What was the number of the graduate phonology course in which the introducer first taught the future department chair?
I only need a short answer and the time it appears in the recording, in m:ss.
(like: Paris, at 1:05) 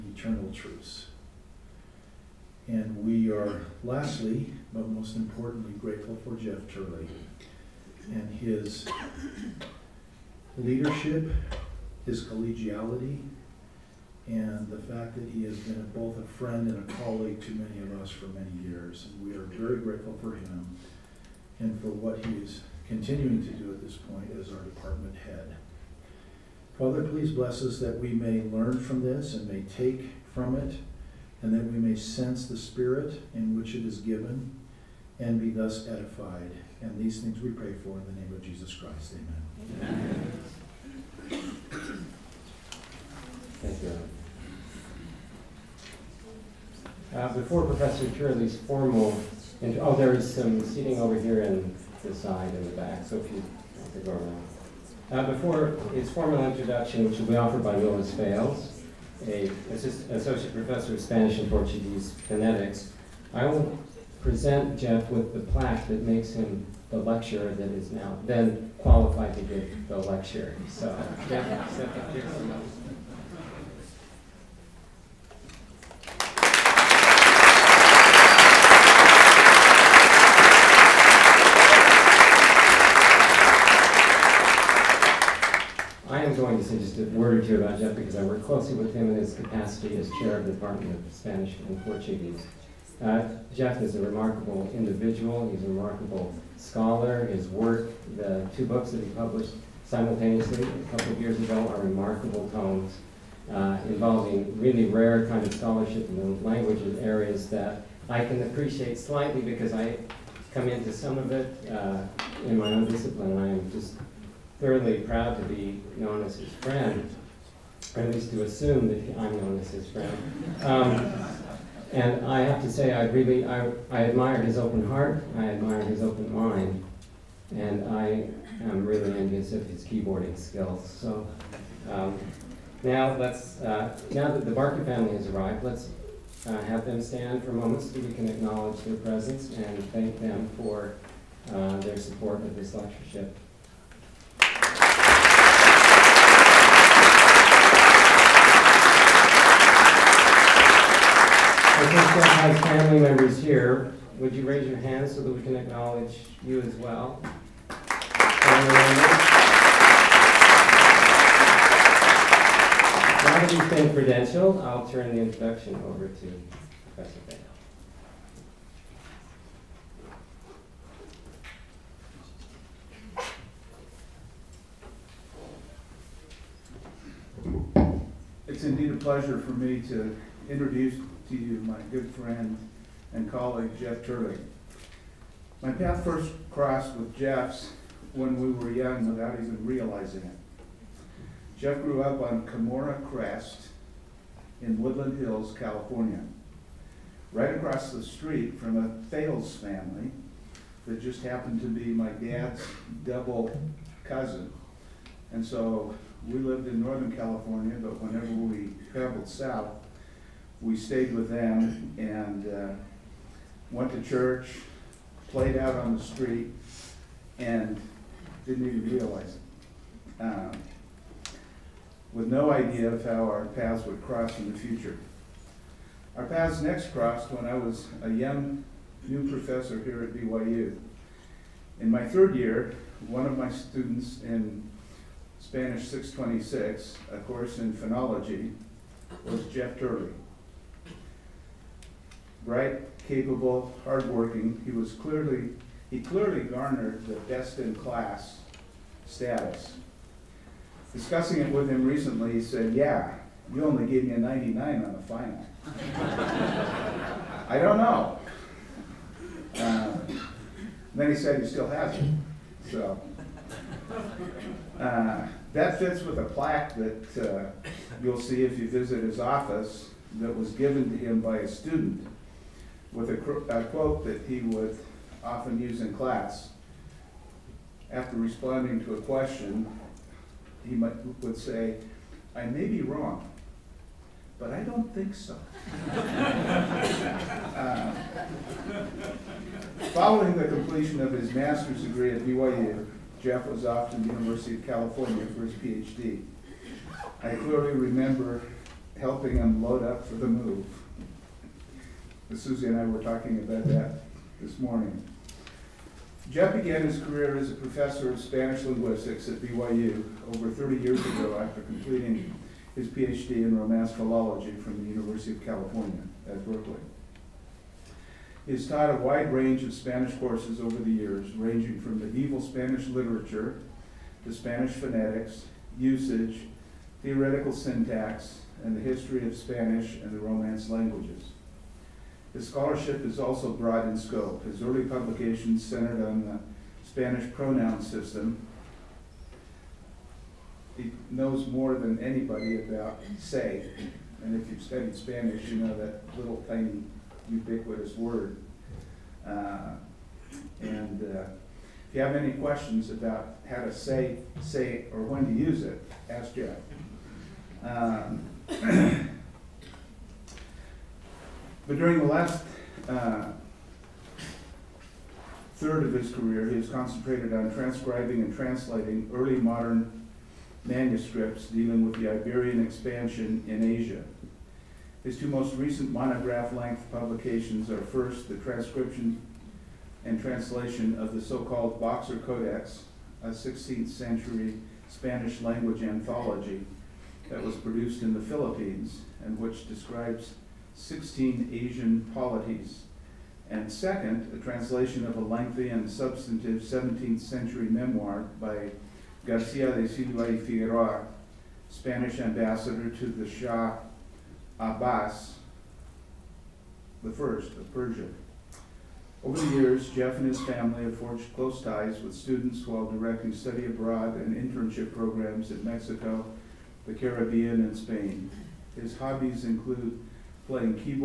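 626, at 3:55.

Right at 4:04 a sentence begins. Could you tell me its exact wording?
He was clearly, he clearly garnered the best in class status.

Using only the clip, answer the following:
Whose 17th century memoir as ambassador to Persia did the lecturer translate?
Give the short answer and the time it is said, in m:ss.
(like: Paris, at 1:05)
Garcia de Silva y Figueroa, at 6:39.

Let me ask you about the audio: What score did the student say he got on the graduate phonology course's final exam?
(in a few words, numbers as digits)
99.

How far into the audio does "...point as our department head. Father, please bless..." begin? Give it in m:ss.
0:23.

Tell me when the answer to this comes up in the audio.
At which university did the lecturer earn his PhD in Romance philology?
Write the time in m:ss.
5:14.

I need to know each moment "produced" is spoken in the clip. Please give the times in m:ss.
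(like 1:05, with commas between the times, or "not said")
6:27.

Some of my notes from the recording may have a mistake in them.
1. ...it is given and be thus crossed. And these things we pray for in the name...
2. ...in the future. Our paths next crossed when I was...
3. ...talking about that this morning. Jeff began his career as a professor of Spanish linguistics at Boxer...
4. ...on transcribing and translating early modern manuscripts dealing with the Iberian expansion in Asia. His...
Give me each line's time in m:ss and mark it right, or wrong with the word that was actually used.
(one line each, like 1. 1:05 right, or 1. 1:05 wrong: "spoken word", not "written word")
1. 0:33 wrong: "edified", not "crossed"
2. 3:44 right
3. 5:03 wrong: "BYU", not "Boxer"
4. 6:07 right.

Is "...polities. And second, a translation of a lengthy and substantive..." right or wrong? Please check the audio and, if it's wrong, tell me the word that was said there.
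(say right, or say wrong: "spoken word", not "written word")
right.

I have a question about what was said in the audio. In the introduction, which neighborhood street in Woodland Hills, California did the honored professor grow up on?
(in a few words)
Camorra Crest.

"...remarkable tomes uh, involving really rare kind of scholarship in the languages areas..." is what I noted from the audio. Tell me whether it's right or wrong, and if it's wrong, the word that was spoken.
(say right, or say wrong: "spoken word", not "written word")
right.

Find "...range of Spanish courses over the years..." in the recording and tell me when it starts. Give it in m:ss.
5:19.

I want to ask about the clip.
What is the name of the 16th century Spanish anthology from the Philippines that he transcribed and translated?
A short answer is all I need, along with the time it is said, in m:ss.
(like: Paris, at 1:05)
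Boxer Codex, at 6:21.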